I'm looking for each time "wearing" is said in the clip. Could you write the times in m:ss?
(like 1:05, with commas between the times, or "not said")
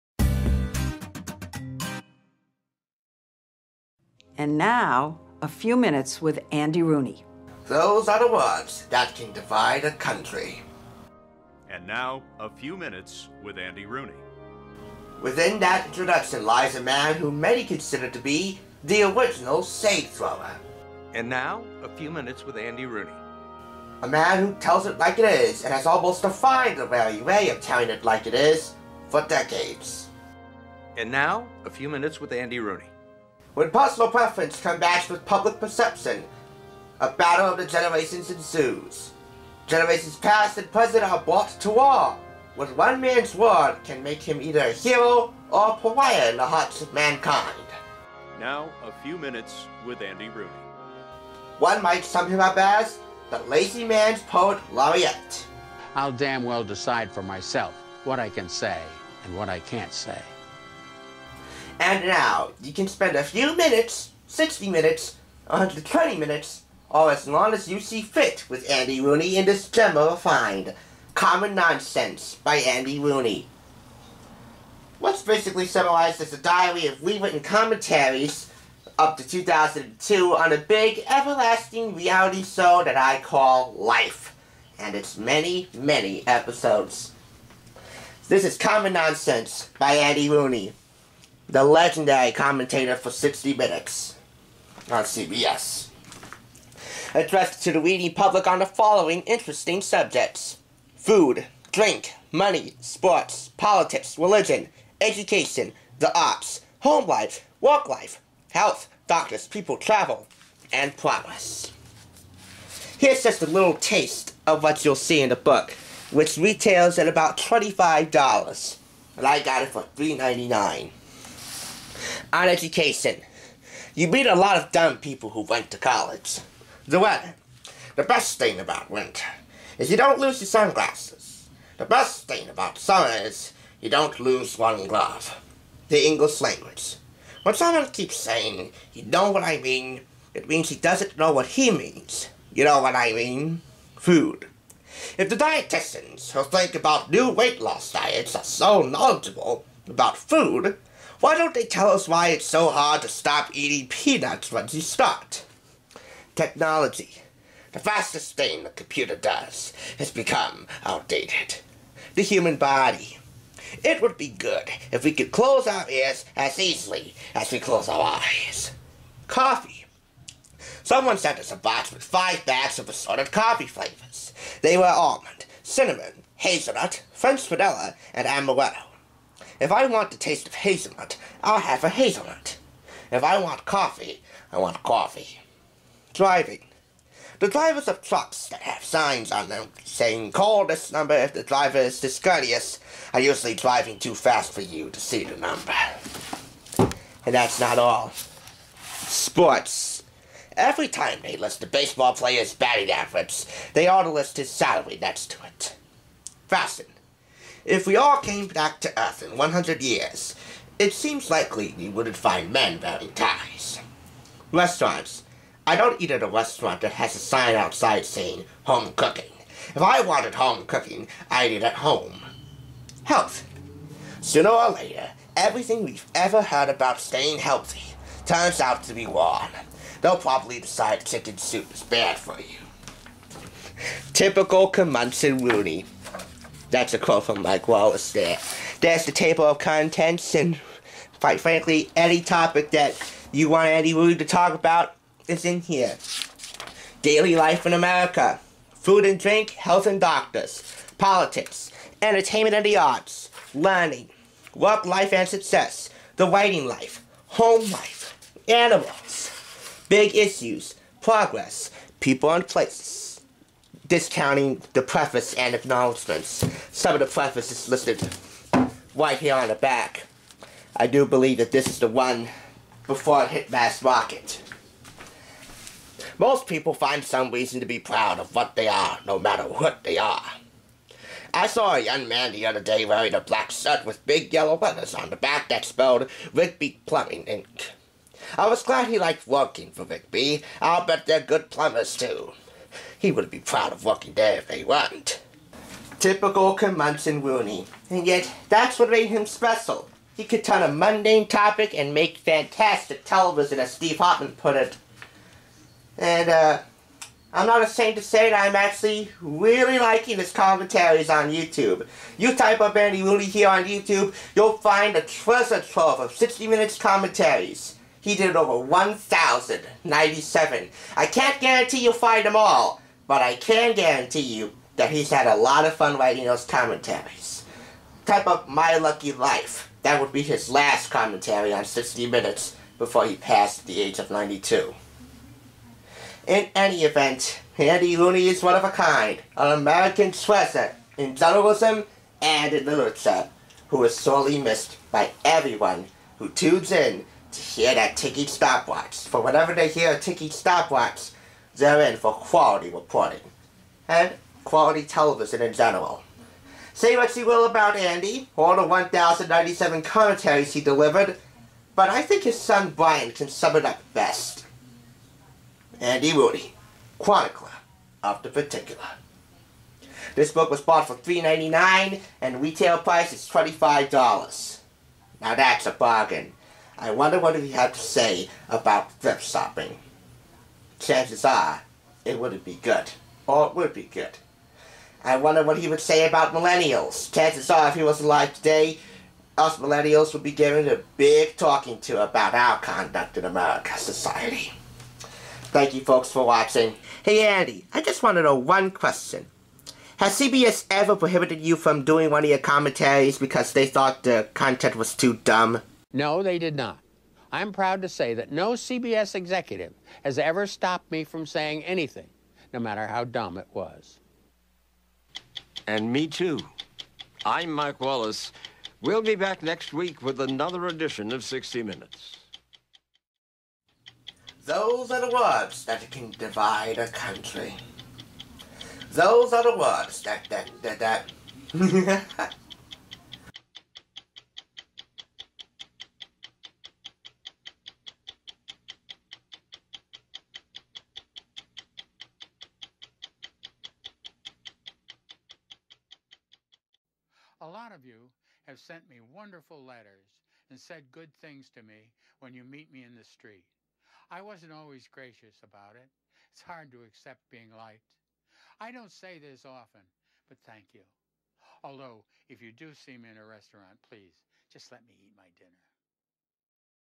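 3:32, 4:42.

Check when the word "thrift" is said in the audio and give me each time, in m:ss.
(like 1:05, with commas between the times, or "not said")
6:18.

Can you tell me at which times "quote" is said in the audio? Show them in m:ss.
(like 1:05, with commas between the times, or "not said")
3:56.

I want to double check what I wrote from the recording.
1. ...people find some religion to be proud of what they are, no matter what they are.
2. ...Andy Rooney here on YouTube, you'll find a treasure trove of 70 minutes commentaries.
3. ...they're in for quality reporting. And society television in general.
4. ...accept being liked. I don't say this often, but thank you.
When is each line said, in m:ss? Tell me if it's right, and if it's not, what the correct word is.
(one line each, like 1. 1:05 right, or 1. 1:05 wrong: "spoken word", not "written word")
1. 4:36 wrong: "reason", not "religion"
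2. 5:12 wrong: "60", not "70"
3. 5:51 wrong: "quality", not "society"
4. 7:36 right.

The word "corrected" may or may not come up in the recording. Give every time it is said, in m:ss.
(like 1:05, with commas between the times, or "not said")
not said.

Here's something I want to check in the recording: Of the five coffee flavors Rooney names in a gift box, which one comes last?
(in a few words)
amaretto.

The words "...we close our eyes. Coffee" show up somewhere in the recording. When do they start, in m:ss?
2:47.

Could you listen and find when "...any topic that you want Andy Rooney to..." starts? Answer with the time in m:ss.
4:01.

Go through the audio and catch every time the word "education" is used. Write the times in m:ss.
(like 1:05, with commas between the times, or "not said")
1:45, 2:02.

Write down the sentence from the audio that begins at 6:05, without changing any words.
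Andy Rooney, chronicler of the particular.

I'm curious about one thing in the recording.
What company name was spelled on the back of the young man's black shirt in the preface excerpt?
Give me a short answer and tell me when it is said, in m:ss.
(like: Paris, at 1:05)
Rigby Plumbing Inc., at 4:46.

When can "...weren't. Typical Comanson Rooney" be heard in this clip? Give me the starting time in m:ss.
4:54.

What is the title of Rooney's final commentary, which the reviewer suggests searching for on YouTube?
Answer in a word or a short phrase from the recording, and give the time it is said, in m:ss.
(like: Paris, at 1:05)
My Lucky Life, at 5:28.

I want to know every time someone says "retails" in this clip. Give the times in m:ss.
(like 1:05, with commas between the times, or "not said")
1:56, 6:12.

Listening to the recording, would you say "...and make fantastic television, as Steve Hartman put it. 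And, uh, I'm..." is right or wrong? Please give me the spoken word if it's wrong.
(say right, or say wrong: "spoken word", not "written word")
right.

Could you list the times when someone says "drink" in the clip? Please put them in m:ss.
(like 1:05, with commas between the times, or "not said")
1:41, 4:09.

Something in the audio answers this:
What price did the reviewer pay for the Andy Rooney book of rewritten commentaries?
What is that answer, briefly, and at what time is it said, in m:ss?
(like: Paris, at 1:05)
$3.99, at 1:59.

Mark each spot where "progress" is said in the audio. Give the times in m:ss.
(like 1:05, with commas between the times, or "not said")
1:50, 4:21.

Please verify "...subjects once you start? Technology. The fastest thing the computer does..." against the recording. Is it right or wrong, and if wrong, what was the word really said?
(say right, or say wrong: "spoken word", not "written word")
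wrong: "peanuts", not "subjects".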